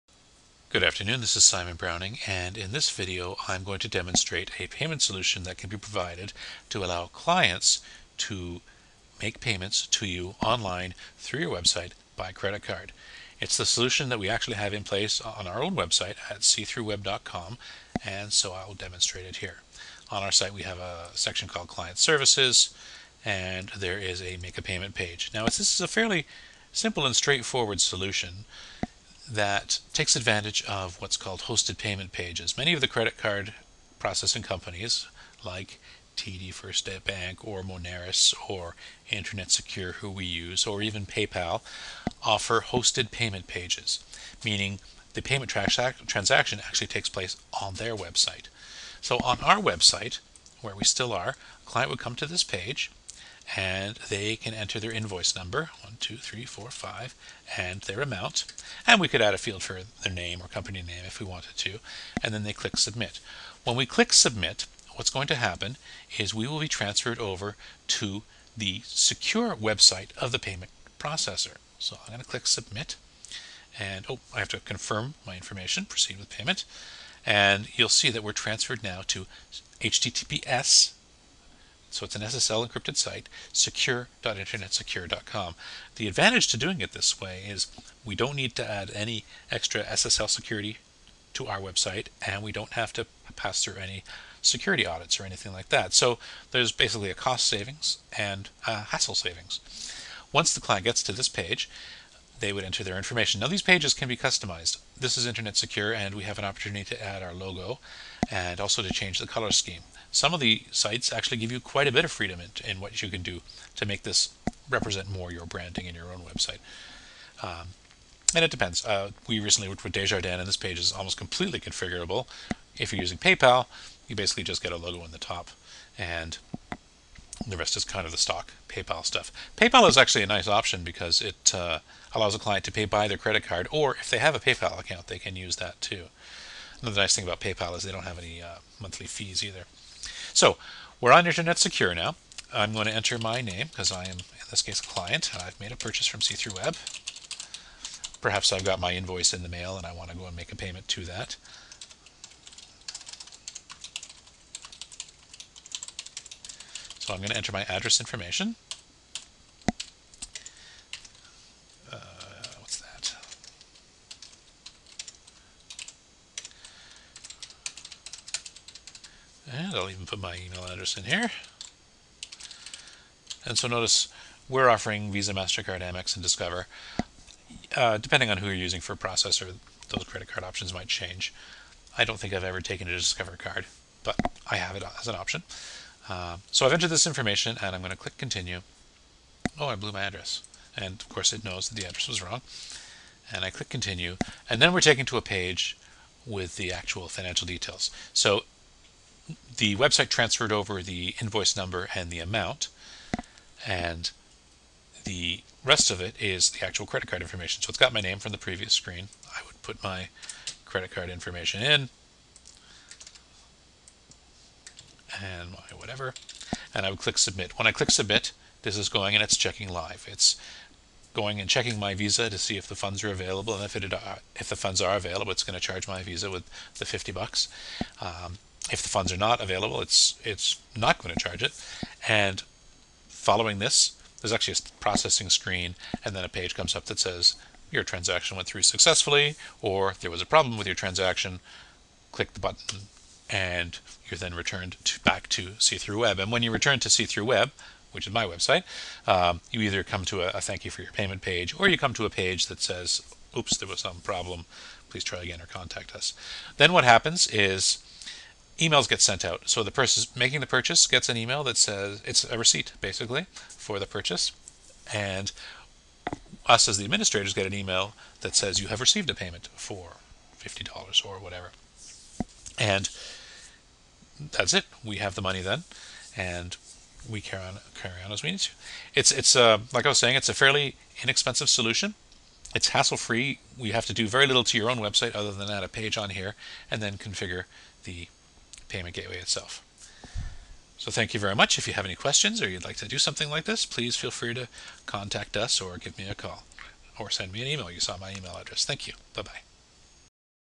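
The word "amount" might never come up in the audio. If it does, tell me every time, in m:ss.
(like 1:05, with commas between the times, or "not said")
0:58, 3:22.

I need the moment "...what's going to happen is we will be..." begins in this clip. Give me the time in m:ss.
1:04.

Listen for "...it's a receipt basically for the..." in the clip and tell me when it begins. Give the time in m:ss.
4:22.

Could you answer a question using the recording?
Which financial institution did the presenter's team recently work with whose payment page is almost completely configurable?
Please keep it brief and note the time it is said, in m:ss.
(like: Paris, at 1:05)
Desjardins, at 1:59.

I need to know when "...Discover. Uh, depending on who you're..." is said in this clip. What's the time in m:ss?
2:56.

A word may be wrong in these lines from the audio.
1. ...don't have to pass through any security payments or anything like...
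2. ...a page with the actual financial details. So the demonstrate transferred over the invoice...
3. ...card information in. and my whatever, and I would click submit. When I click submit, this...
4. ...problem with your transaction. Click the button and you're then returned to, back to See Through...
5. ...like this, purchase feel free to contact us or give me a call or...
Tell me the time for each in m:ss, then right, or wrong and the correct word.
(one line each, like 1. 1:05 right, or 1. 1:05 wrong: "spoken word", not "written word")
1. 1:32 wrong: "audits", not "payments"
2. 3:15 wrong: "website", not "demonstrate"
3. 3:30 right
4. 4:00 right
5. 4:53 wrong: "please", not "purchase".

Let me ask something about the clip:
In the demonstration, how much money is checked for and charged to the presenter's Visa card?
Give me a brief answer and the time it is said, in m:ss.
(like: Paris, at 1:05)
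$50, at 3:46.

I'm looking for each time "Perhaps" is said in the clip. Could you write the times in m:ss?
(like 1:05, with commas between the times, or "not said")
2:28.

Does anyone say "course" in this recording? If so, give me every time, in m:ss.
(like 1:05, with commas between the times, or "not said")
3:11.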